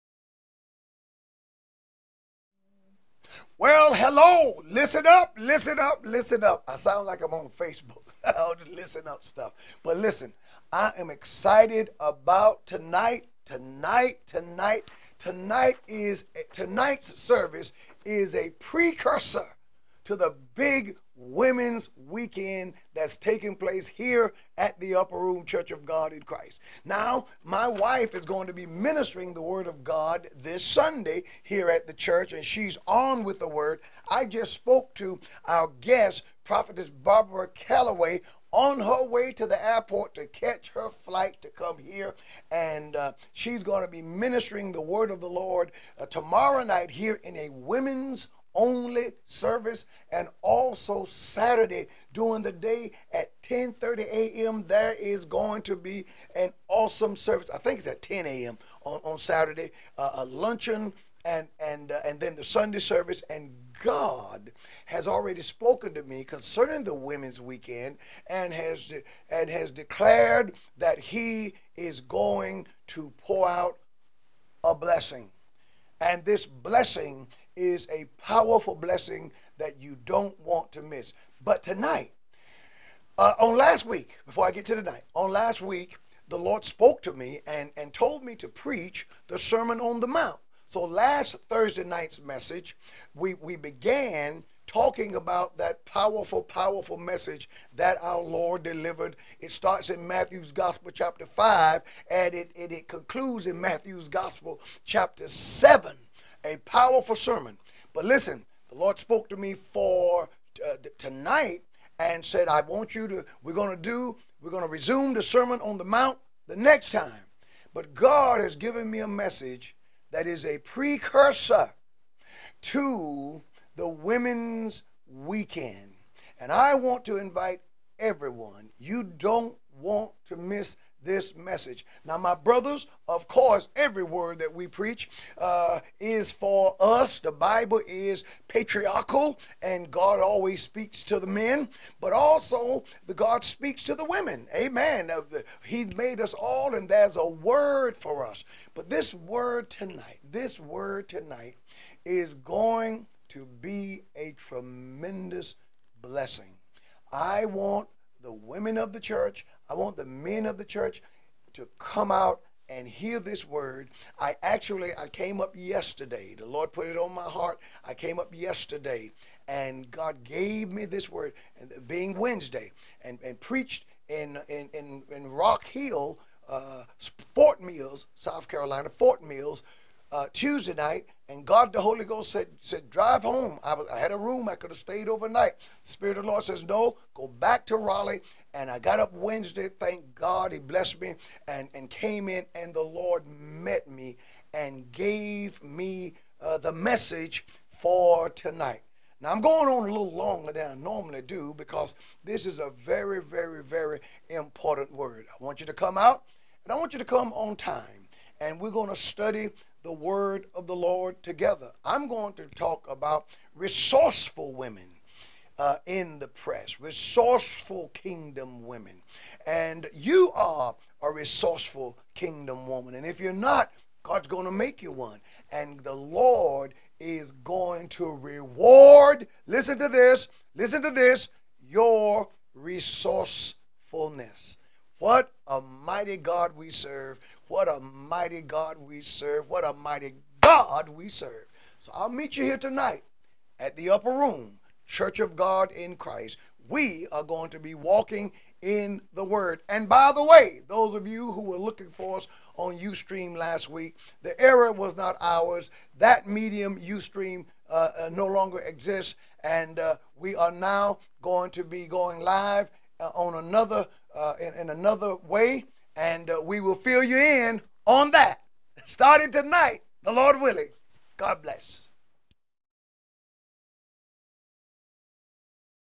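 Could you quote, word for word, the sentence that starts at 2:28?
But this word tonight, this word tonight, is going to be a tremendous blessing.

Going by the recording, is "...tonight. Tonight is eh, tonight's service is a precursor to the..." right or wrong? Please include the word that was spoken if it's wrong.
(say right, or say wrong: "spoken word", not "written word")
right.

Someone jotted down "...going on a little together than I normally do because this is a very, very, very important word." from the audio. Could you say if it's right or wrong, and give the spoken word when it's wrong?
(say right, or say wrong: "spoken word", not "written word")
wrong: "longer", not "together".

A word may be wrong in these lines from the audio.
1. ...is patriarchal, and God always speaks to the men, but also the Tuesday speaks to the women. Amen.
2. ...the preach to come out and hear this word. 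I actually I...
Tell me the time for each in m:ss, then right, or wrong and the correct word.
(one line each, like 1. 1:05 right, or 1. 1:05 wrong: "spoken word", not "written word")
1. 2:17 wrong: "God", not "Tuesday"
2. 2:40 wrong: "church", not "preach".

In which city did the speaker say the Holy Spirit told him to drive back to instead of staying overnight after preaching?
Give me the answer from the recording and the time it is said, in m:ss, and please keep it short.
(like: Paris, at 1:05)
Raleigh, at 3:07.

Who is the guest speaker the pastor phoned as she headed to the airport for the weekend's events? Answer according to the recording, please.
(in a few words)
Barbara Calloway.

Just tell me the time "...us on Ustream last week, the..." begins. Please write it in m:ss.
4:12.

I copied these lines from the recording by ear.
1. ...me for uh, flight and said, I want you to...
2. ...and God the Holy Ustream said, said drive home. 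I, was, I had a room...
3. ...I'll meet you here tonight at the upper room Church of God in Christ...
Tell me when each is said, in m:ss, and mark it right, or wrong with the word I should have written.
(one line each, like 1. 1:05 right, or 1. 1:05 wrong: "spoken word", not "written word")
1. 1:49 wrong: "tonight", not "flight"
2. 3:01 wrong: "Ghost", not "Ustream"
3. 4:01 right.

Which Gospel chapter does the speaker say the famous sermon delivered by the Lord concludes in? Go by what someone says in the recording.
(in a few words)
Chapter 7.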